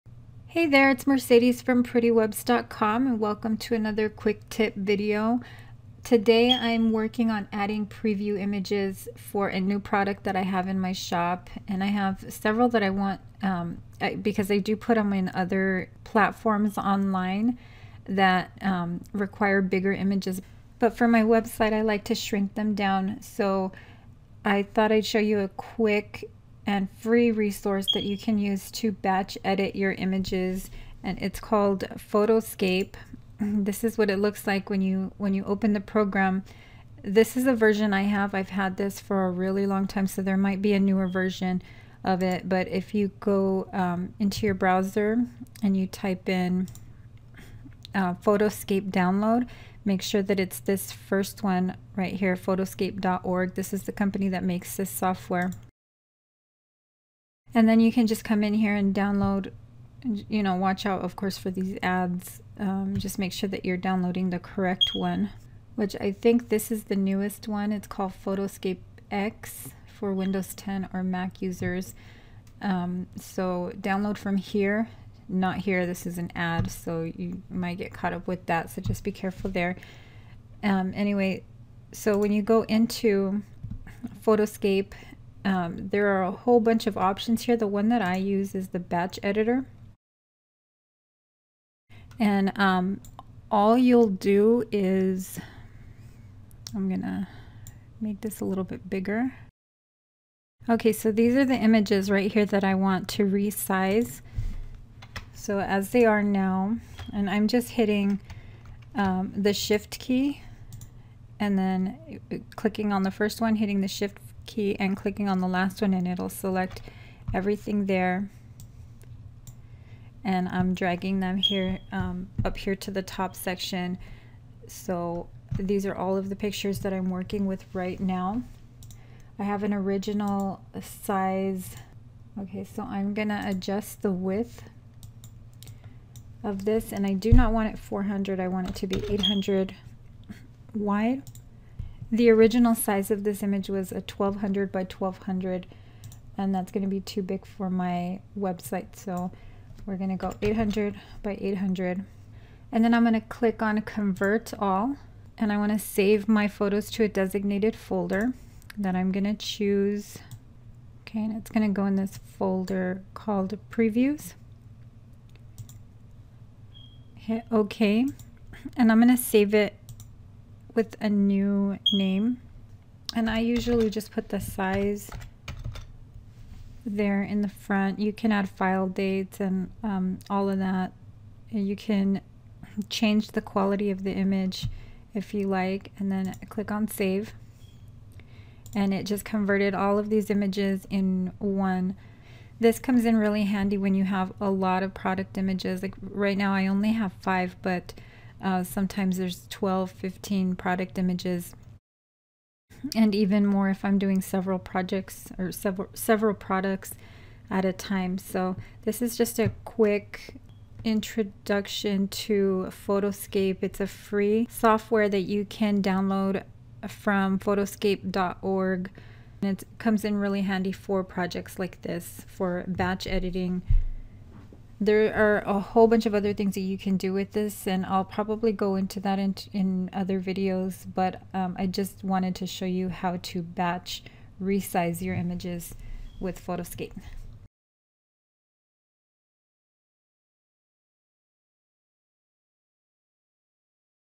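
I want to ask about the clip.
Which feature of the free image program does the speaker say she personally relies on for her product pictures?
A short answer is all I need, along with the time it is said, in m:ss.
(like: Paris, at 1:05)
batch editor, at 1:28.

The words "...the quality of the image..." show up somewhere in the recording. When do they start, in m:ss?
3:03.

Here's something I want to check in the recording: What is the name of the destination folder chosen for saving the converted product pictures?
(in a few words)
previews.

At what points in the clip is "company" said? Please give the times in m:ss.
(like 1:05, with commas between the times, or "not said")
0:53.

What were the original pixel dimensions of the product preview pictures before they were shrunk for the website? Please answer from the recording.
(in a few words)
1200 by 1200.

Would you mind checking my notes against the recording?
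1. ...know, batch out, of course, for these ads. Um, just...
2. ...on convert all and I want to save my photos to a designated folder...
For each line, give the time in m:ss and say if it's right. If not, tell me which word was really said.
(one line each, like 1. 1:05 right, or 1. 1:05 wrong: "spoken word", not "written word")
1. 1:00 wrong: "watch", not "batch"
2. 2:33 right.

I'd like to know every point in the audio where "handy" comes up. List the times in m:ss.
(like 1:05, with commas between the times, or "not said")
3:13, 3:40.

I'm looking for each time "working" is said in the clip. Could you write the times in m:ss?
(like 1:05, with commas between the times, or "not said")
0:06, 2:07.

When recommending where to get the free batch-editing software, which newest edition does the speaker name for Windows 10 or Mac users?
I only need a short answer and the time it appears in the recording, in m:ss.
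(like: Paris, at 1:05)
Photoscape X, at 1:08.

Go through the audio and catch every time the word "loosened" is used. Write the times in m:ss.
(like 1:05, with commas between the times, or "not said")
not said.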